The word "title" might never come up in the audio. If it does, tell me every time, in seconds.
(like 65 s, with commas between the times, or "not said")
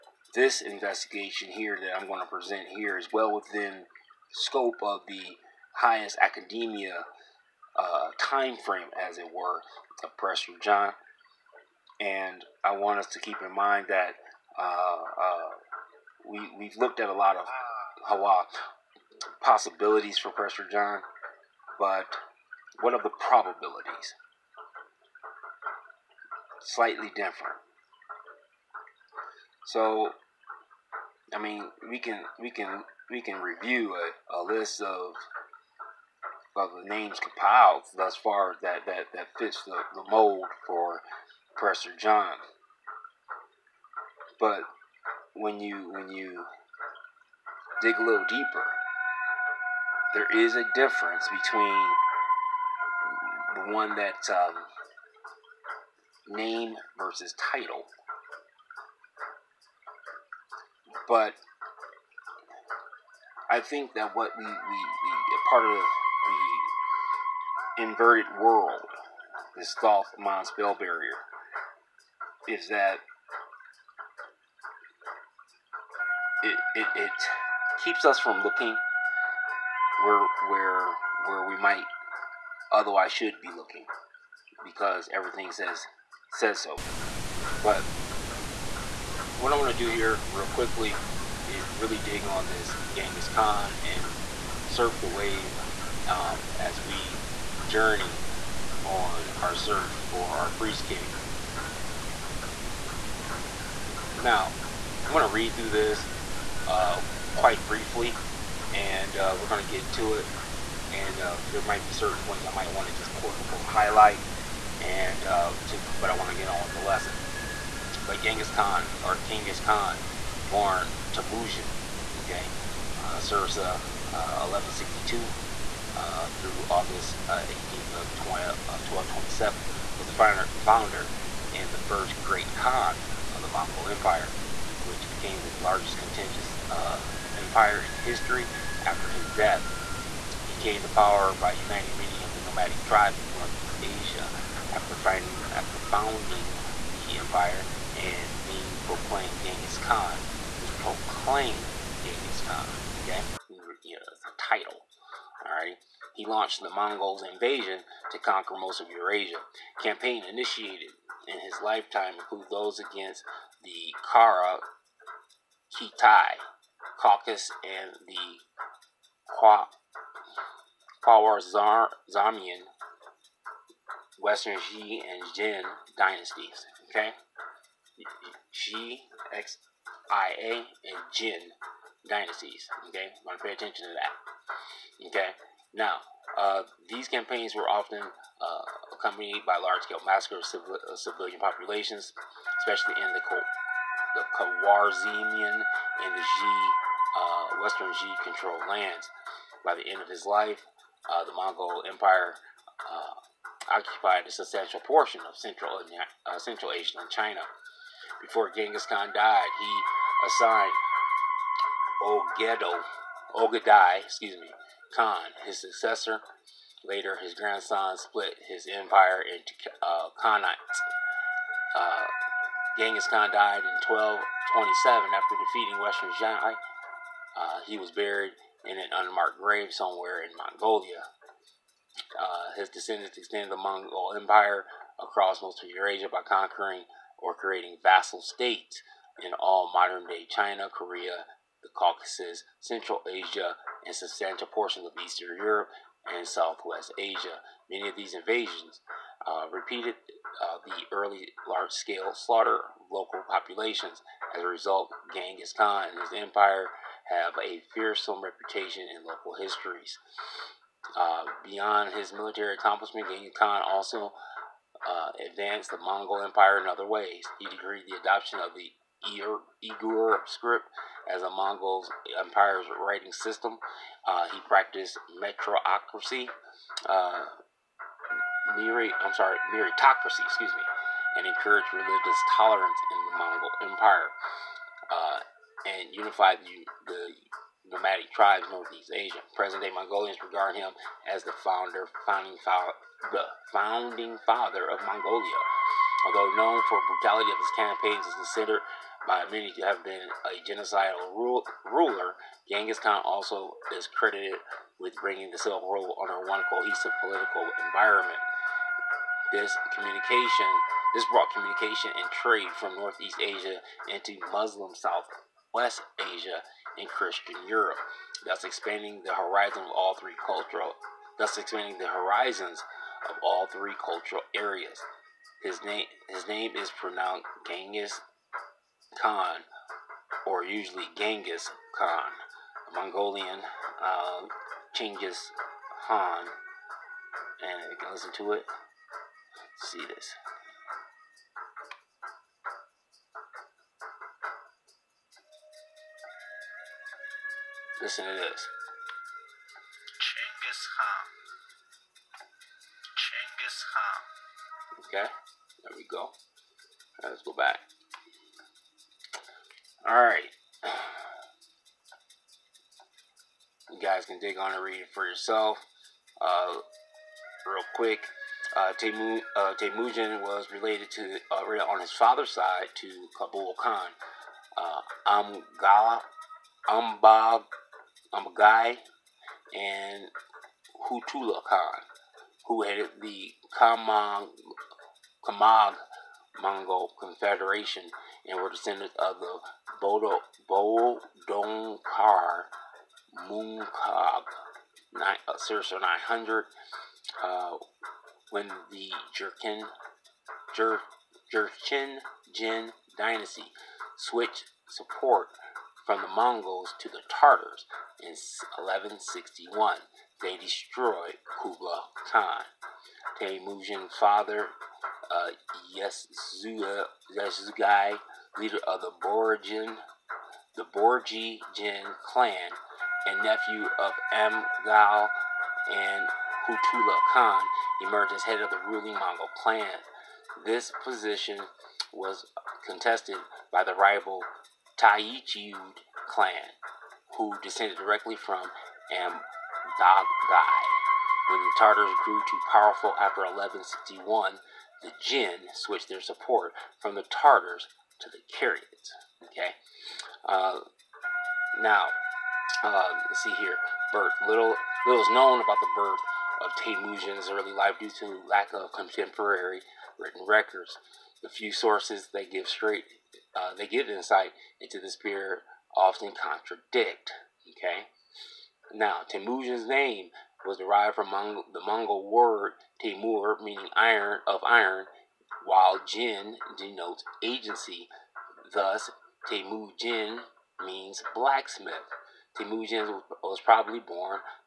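57 s, 154 s.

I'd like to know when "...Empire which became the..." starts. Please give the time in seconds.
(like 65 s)
133 s.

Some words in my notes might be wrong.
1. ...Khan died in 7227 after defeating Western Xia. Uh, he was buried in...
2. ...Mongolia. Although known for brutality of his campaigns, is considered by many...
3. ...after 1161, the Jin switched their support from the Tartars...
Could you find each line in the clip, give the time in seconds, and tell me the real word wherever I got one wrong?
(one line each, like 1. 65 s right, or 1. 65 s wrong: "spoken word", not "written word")
1. 223 s wrong: "1227", not "7227"
2. 294 s right
3. 442 s right.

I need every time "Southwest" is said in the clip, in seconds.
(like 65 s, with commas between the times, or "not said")
246 s, 314 s.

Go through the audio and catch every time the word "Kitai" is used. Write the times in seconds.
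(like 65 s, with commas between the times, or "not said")
165 s.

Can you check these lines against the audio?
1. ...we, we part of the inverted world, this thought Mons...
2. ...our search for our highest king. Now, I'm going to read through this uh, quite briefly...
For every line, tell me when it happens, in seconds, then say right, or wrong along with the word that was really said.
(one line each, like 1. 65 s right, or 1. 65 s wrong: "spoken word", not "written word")
1. 64 s right
2. 99 s wrong: "priest", not "highest".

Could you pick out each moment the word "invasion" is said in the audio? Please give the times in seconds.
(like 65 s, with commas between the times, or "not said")
157 s, 248 s.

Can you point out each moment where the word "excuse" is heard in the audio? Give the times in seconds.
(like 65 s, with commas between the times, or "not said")
214 s, 280 s.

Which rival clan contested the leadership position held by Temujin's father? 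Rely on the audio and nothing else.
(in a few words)
Taichud.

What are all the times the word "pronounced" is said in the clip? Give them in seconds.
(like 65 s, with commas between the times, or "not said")
326 s.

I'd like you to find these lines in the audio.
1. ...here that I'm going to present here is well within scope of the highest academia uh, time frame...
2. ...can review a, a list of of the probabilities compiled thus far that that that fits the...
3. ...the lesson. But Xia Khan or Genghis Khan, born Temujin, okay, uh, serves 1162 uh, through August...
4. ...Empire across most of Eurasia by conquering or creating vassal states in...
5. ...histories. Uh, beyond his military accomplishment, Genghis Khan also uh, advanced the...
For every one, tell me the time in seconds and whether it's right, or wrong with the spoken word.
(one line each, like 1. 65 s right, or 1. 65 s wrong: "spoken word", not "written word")
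1. 1 s right
2. 33 s wrong: "names", not "probabilities"
3. 116 s wrong: "Genghis", not "Xia"
4. 234 s right
5. 259 s right.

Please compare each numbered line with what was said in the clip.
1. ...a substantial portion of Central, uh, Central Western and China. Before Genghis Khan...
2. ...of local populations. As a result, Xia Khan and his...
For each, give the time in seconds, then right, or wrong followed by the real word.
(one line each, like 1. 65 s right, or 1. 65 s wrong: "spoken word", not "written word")
1. 204 s wrong: "Asia", not "Western"
2. 252 s wrong: "Genghis", not "Xia".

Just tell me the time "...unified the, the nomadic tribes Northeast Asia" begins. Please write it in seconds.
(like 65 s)
285 s.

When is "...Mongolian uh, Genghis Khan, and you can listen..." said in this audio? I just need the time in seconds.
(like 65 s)
332 s.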